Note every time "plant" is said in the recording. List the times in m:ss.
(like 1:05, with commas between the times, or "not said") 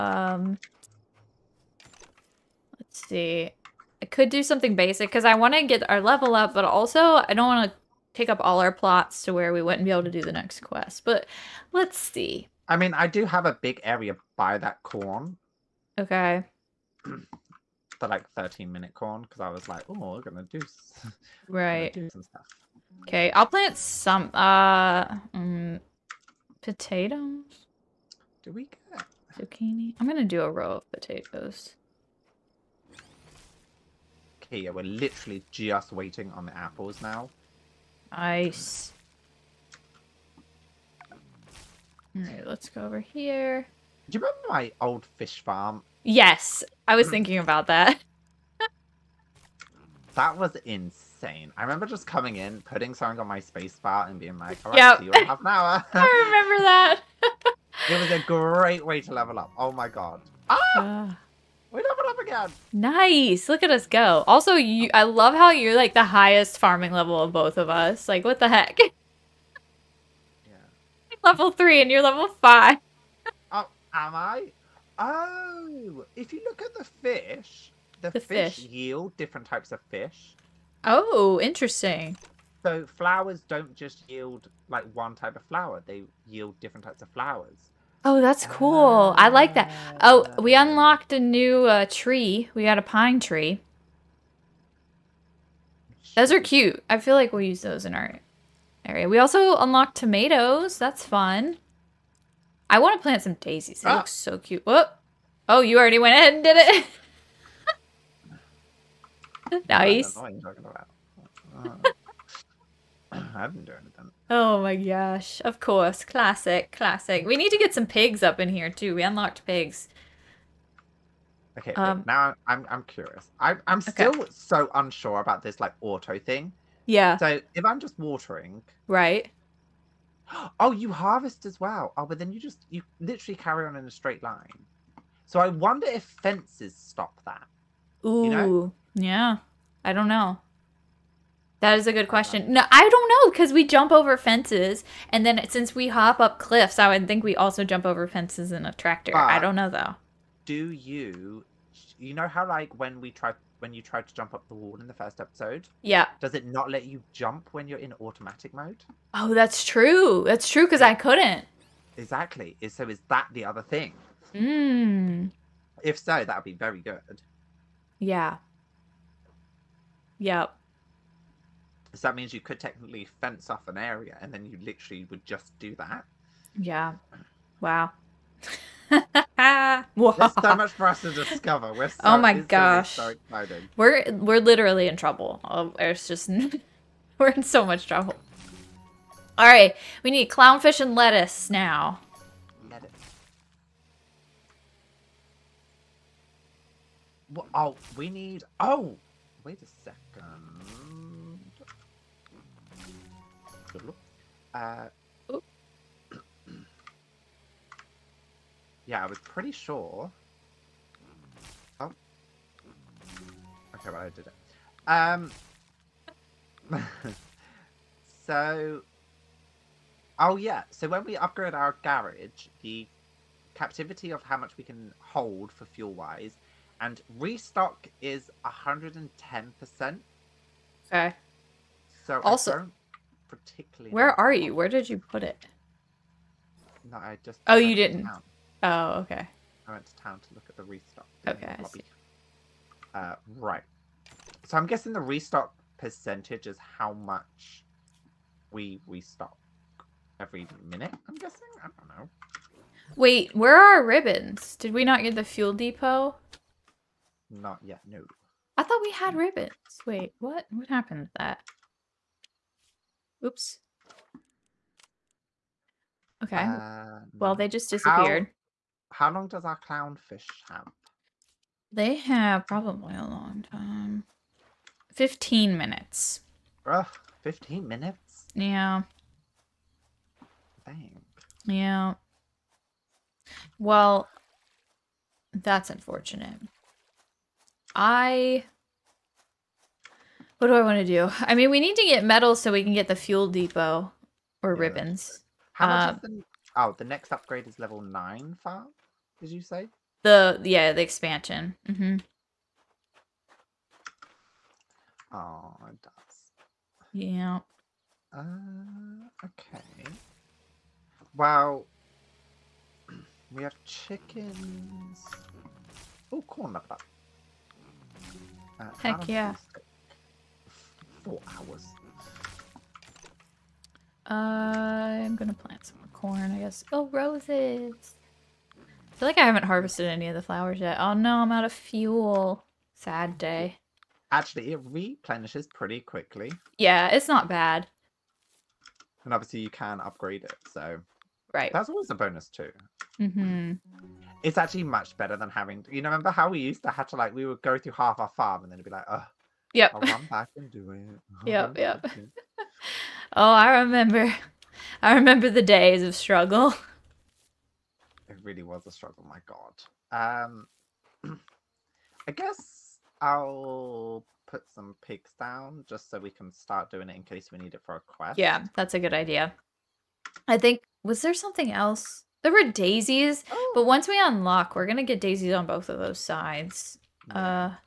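0:23, 1:43, 5:25.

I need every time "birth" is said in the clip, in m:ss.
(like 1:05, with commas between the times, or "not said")
not said.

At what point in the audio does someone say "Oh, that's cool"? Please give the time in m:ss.
1:28.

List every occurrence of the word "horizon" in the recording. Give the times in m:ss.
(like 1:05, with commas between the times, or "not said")
not said.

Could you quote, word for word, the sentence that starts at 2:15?
So I wonder if fences stop that.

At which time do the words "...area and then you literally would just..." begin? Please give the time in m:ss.
2:53.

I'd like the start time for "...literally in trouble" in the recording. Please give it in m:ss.
3:04.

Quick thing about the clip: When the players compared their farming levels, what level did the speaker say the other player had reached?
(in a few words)
5.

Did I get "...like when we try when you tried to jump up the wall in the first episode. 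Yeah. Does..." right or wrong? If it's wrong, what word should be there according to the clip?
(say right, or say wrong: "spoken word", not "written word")
right.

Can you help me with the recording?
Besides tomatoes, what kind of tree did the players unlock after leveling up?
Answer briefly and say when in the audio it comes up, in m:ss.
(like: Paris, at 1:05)
Pine tree, at 1:32.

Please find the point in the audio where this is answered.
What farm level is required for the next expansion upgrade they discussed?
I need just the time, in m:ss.
4:57.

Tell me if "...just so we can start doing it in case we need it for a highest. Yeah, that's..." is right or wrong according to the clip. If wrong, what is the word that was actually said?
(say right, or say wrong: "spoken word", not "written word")
wrong: "quest", not "highest".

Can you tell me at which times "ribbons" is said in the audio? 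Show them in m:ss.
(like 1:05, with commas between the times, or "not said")
4:13, 4:19, 4:54.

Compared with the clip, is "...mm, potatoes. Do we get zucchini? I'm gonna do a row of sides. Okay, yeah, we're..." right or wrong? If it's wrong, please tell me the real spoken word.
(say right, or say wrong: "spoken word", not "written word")
wrong: "potatoes", not "sides".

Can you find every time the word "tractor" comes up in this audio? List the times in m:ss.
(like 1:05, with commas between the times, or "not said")
2:28.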